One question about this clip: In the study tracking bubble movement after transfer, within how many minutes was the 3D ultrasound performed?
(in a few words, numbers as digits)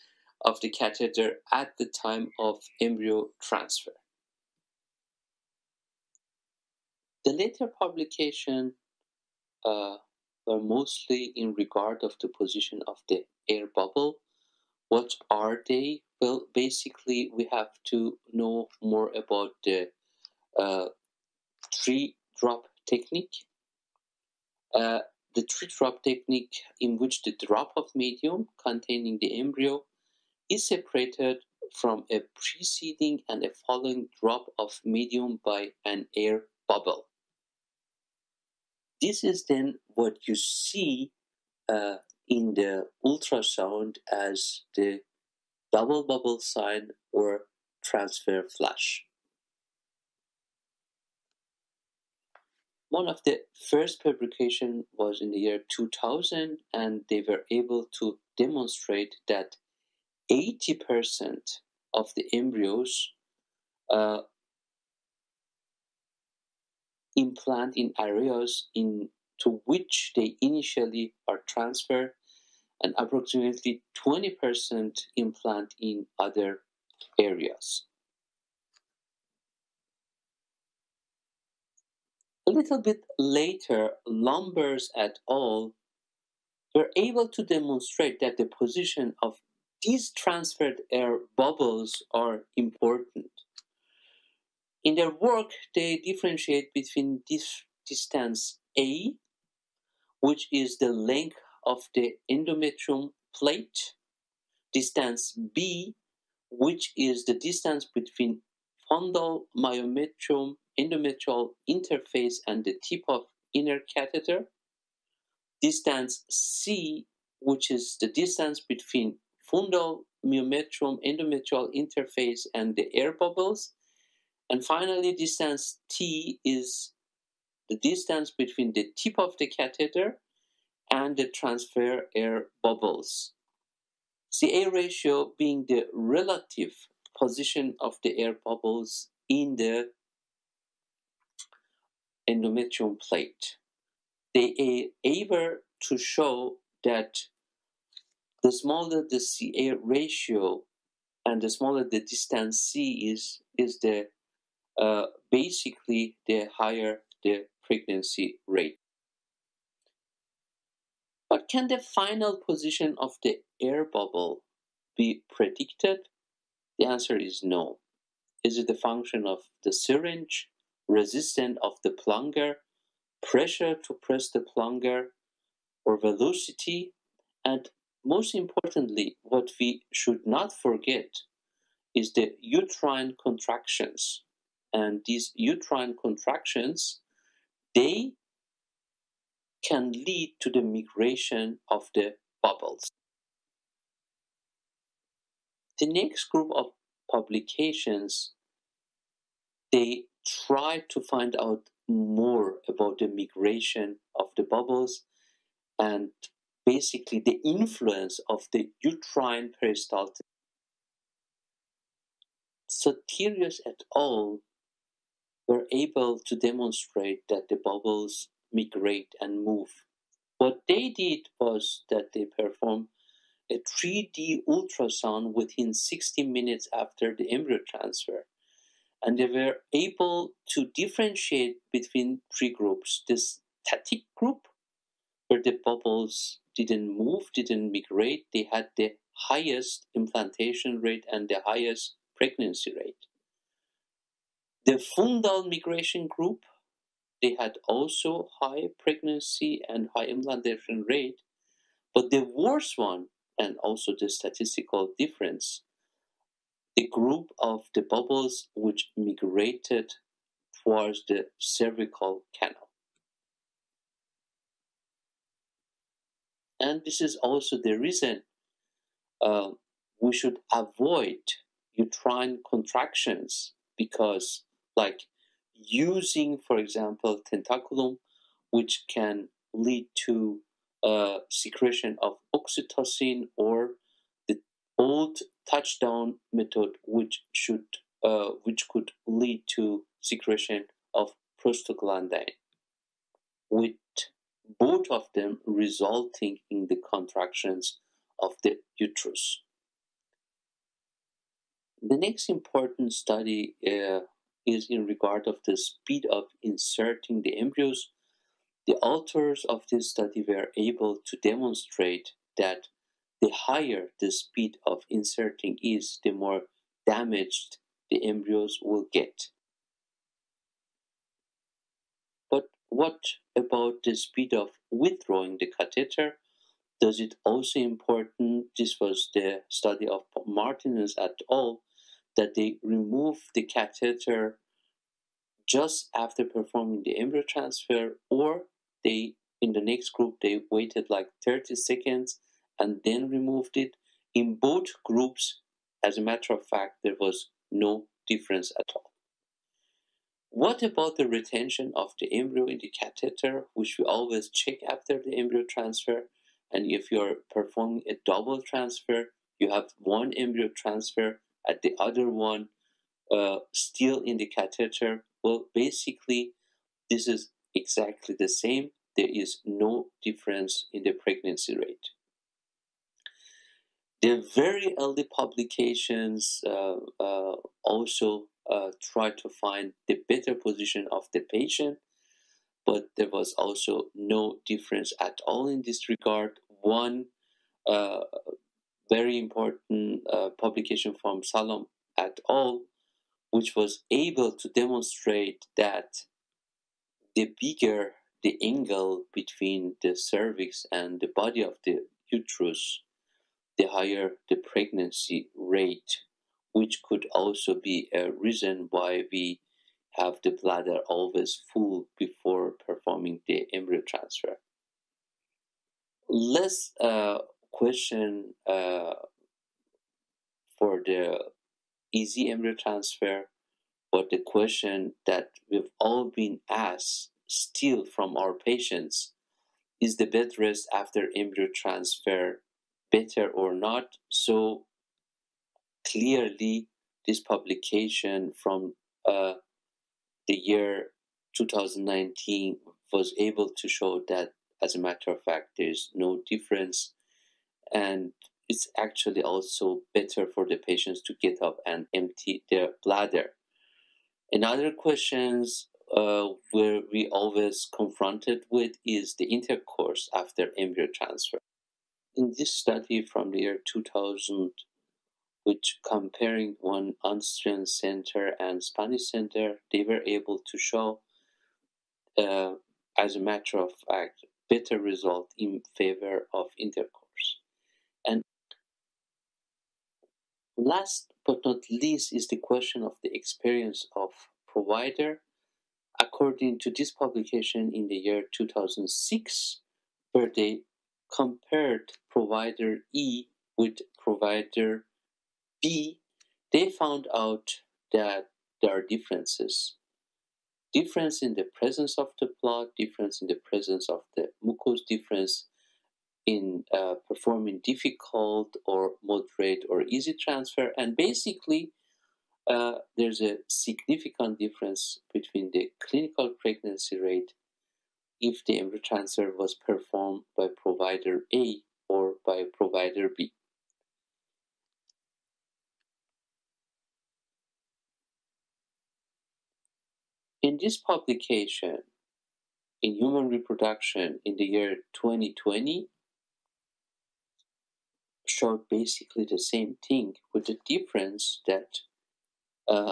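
60 minutes.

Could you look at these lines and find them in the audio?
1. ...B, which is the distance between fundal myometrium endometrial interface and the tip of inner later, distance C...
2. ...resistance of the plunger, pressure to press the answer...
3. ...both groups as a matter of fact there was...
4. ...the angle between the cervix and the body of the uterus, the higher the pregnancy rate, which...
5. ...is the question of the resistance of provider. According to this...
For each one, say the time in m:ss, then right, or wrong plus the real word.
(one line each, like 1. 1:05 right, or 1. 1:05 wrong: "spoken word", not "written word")
1. 1:45 wrong: "catheter", not "later"
2. 2:50 wrong: "plunger", not "answer"
3. 5:44 right
4. 6:38 right
5. 8:02 wrong: "experience", not "resistance".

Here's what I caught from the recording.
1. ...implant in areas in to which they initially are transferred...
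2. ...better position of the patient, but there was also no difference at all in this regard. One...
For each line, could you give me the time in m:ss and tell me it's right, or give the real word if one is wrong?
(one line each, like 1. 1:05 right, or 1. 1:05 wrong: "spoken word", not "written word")
1. 1:07 right
2. 6:20 right.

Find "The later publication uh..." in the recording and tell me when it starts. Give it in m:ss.
0:07.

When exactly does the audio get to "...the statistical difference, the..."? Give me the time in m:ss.
4:13.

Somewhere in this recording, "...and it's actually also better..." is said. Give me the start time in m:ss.
7:27.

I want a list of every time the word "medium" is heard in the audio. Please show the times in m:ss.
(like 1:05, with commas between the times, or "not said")
0:27, 0:34.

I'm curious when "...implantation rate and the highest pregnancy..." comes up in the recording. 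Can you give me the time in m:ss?
3:59.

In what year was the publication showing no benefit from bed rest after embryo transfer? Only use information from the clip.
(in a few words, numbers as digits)
2019.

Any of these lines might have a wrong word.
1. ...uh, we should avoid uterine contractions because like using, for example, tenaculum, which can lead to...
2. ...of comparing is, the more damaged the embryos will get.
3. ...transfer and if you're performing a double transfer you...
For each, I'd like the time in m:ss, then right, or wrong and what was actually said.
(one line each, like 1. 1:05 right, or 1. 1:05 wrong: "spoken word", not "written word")
1. 4:29 right
2. 5:14 wrong: "inserting", not "comparing"
3. 5:55 right.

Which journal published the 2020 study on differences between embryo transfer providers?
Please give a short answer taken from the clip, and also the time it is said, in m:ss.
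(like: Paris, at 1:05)
Human Reproduction, at 8:52.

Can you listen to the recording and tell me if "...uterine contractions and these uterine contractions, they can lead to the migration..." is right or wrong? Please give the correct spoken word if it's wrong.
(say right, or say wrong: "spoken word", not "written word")
right.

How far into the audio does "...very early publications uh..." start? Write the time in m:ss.
6:14.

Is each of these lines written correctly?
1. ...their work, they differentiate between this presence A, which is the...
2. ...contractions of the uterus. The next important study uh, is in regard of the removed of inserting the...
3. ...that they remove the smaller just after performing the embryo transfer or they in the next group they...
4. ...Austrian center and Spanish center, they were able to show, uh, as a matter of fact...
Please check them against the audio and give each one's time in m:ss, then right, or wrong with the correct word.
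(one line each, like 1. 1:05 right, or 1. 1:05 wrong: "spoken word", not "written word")
1. 1:34 wrong: "distance", not "presence"
2. 4:56 wrong: "speed", not "removed"
3. 5:32 wrong: "catheter", not "smaller"
4. 7:47 right.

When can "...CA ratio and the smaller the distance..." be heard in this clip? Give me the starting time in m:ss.
2:29.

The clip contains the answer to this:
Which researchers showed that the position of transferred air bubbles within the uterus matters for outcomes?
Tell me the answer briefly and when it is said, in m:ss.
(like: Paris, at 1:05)
Lambers et al., at 1:24.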